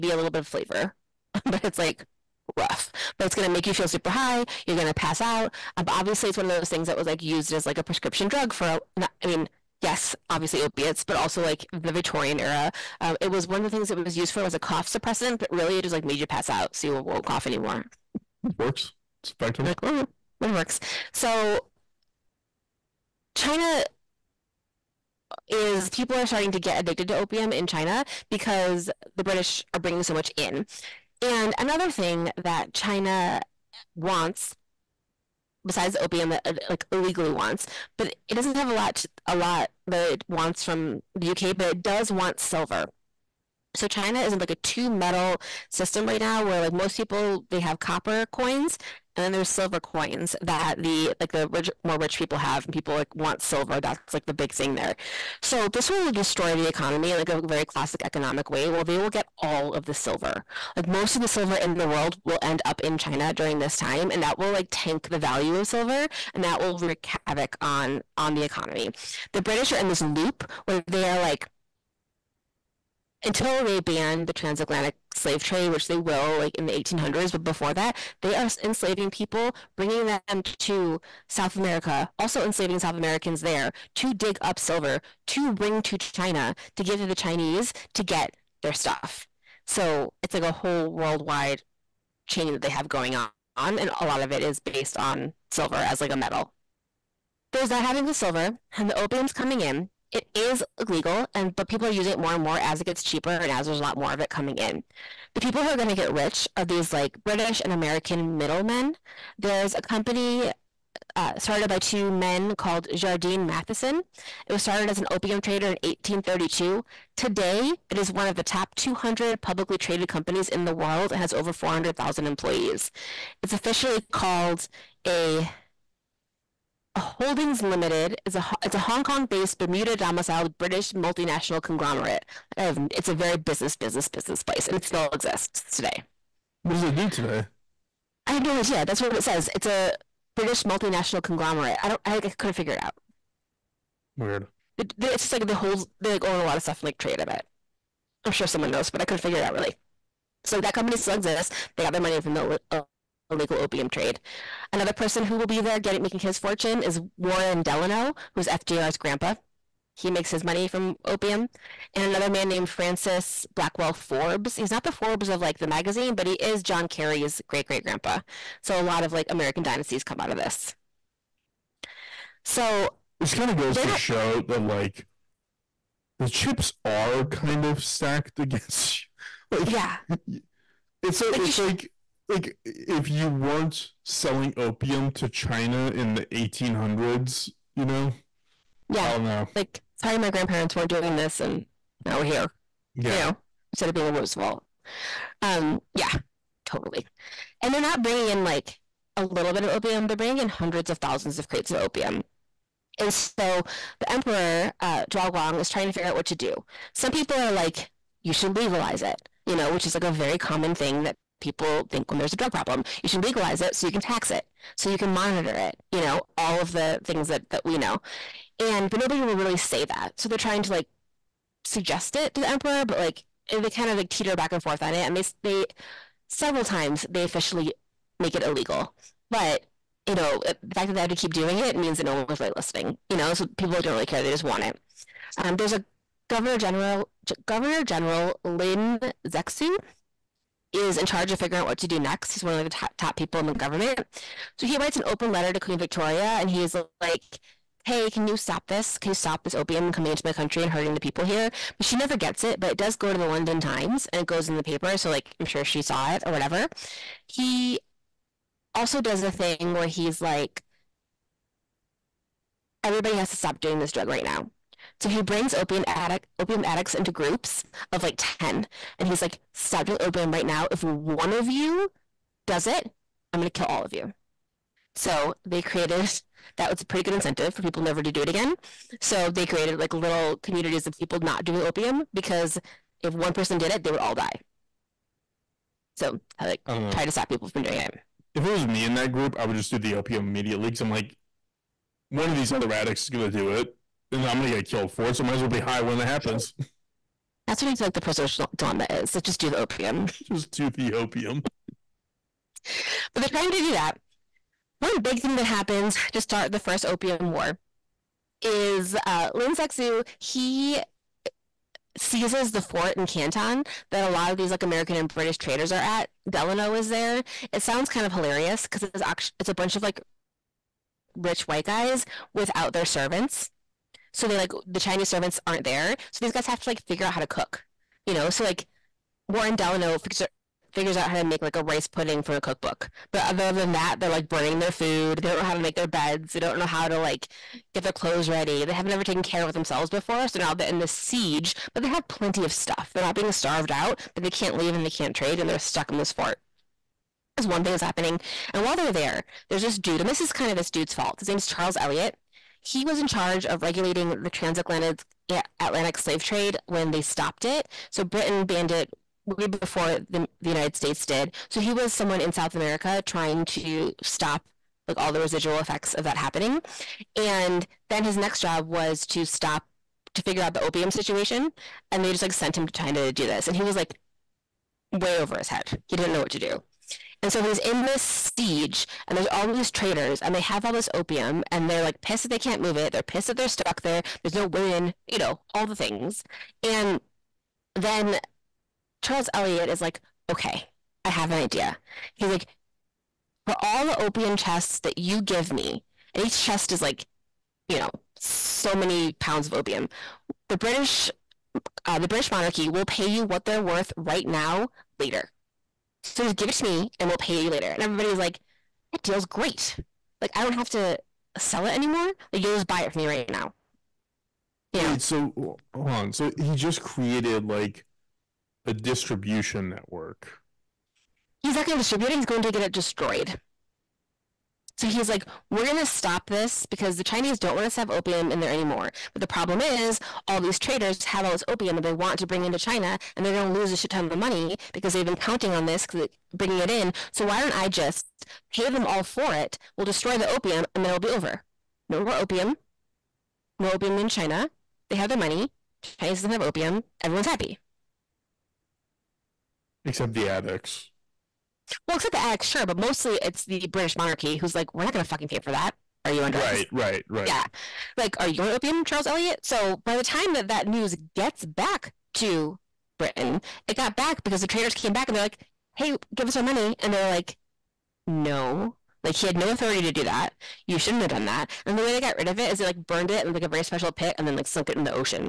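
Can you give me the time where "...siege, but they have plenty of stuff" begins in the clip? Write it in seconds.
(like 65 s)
340 s.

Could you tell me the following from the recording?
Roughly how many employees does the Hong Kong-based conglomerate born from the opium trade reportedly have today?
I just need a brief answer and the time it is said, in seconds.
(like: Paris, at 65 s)
over 400,000, at 121 s.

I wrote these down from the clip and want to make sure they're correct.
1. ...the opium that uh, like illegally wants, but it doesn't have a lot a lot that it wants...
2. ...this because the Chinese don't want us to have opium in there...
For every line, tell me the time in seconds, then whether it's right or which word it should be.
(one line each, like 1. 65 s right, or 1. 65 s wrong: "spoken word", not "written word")
1. 35 s right
2. 426 s right.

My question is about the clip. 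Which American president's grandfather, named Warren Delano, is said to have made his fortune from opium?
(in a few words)
FDR.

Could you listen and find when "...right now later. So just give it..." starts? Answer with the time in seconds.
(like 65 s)
403 s.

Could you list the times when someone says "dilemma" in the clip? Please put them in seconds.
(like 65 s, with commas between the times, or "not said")
298 s.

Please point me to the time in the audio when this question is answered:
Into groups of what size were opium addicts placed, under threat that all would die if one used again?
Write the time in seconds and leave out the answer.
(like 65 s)
268 s.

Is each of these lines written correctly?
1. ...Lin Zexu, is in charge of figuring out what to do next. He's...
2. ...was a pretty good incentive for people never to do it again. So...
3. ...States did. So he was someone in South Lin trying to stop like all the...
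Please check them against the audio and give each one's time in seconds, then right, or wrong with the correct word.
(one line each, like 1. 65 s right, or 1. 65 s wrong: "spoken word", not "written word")
1. 238 s right
2. 276 s right
3. 360 s wrong: "America", not "Lin".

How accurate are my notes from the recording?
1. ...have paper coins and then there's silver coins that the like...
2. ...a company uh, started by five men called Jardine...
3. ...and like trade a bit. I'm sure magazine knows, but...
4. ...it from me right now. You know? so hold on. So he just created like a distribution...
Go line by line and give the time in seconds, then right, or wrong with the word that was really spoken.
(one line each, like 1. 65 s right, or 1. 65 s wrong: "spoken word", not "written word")
1. 47 s wrong: "copper", not "paper"
2. 109 s wrong: "two", not "five"
3. 146 s wrong: "someone", not "magazine"
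4. 412 s right.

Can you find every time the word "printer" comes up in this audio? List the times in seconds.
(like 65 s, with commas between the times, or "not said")
not said.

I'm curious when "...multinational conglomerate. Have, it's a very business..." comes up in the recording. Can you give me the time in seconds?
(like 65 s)
130 s.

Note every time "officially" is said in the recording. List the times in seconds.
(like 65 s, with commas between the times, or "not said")
123 s, 227 s.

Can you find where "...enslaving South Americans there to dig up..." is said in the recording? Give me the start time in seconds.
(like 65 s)
82 s.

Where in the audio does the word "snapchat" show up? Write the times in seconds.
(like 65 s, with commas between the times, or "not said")
not said.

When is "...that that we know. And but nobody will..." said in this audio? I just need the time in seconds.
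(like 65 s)
217 s.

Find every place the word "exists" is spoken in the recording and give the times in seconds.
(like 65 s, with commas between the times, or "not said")
135 s, 151 s.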